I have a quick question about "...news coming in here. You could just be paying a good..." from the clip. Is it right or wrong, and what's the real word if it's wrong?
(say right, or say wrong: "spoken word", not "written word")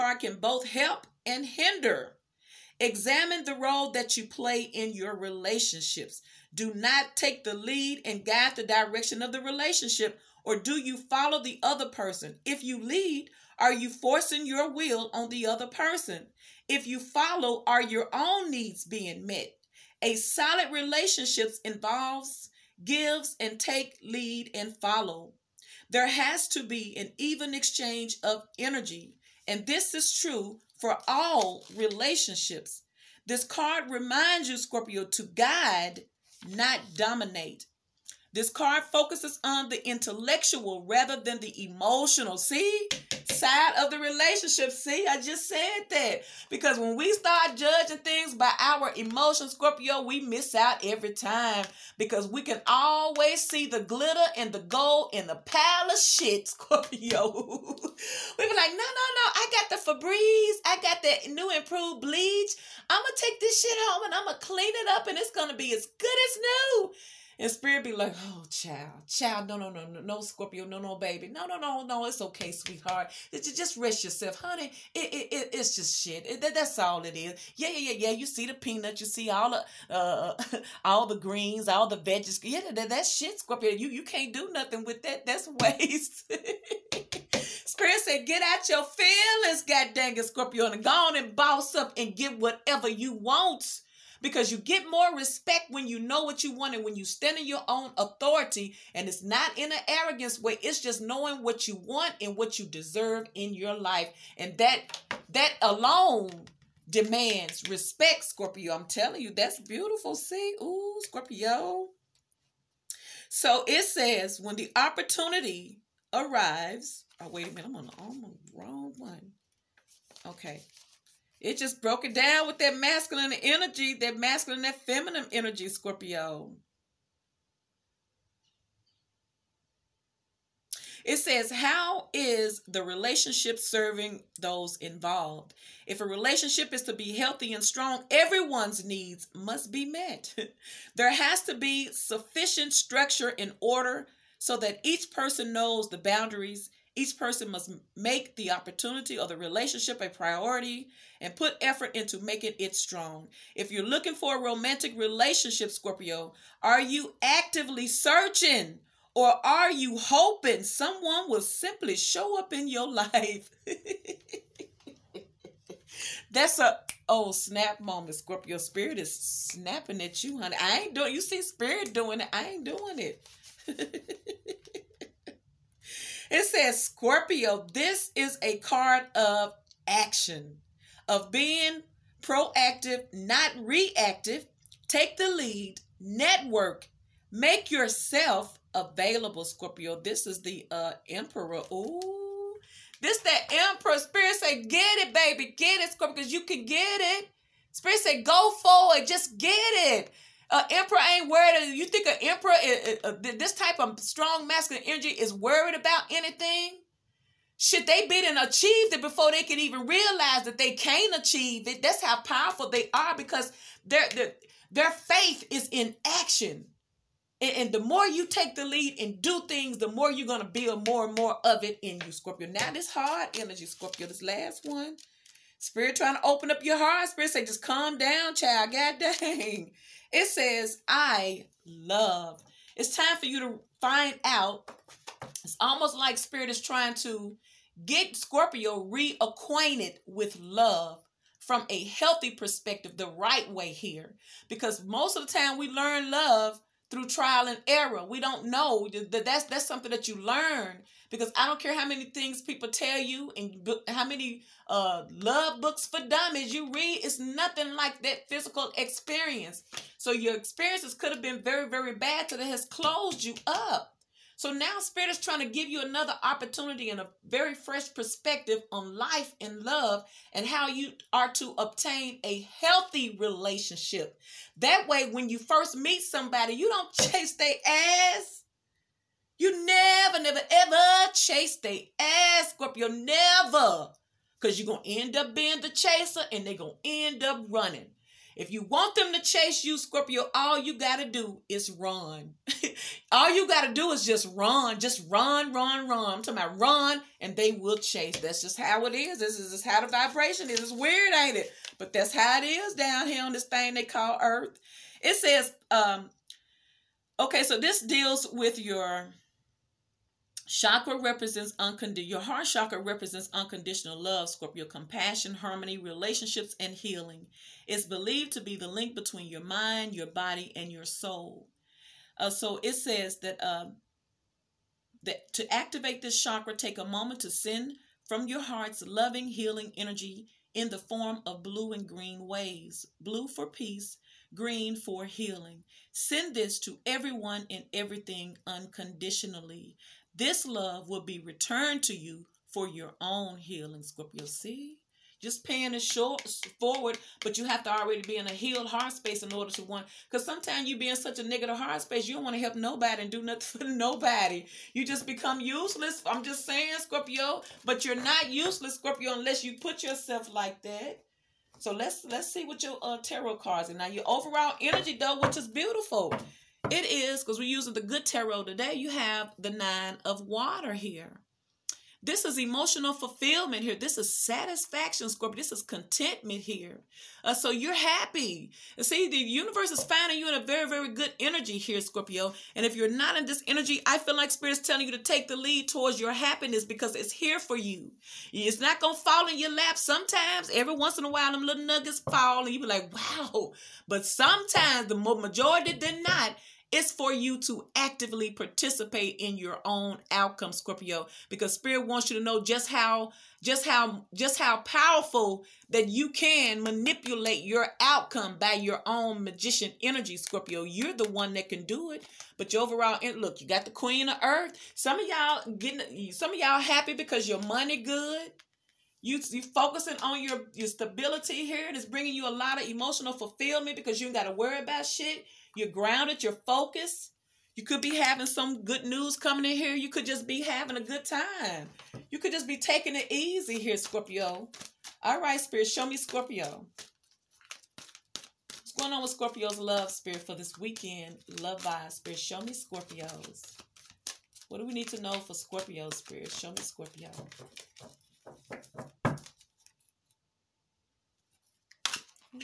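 wrong: "having", not "paying".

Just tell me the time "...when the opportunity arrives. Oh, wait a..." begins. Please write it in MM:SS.
01:54.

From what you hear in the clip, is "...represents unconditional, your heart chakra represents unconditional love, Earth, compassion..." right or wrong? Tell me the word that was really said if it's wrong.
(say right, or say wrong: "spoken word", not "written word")
wrong: "Scorpio", not "Earth".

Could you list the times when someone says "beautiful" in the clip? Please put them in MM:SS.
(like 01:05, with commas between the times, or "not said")
01:49, 06:05.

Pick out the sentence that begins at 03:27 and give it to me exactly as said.
Should they be and achieved it before they can even realize that they can not achieve it?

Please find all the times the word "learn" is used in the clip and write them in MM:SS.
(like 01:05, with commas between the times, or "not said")
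04:05, 04:10.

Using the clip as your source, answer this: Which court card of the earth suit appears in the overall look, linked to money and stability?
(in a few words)
Queen of earth.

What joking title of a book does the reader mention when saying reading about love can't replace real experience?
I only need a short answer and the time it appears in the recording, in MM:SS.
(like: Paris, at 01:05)
love books for dummies, at 04:15.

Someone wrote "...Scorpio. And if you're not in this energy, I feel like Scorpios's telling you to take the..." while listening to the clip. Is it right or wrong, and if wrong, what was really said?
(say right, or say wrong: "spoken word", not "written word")
wrong: "Spirit", not "Scorpios".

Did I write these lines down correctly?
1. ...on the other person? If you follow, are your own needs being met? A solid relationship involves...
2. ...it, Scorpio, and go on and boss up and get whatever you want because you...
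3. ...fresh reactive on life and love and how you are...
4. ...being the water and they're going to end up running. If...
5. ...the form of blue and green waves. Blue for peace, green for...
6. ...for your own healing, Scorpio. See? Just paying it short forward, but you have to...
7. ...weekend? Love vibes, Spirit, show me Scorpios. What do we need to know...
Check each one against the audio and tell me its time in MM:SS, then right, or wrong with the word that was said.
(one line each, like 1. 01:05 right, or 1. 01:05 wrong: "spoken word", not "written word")
1. 00:15 right
2. 01:30 right
3. 04:27 wrong: "perspective", not "reactive"
4. 04:45 wrong: "chaser", not "water"
5. 05:30 right
6. 05:42 right
7. 07:20 right.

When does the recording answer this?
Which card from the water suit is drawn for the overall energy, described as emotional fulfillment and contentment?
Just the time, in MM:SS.
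06:09.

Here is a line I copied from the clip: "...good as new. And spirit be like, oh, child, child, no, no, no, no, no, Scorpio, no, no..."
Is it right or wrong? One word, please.
right.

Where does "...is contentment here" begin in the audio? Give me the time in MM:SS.
06:15.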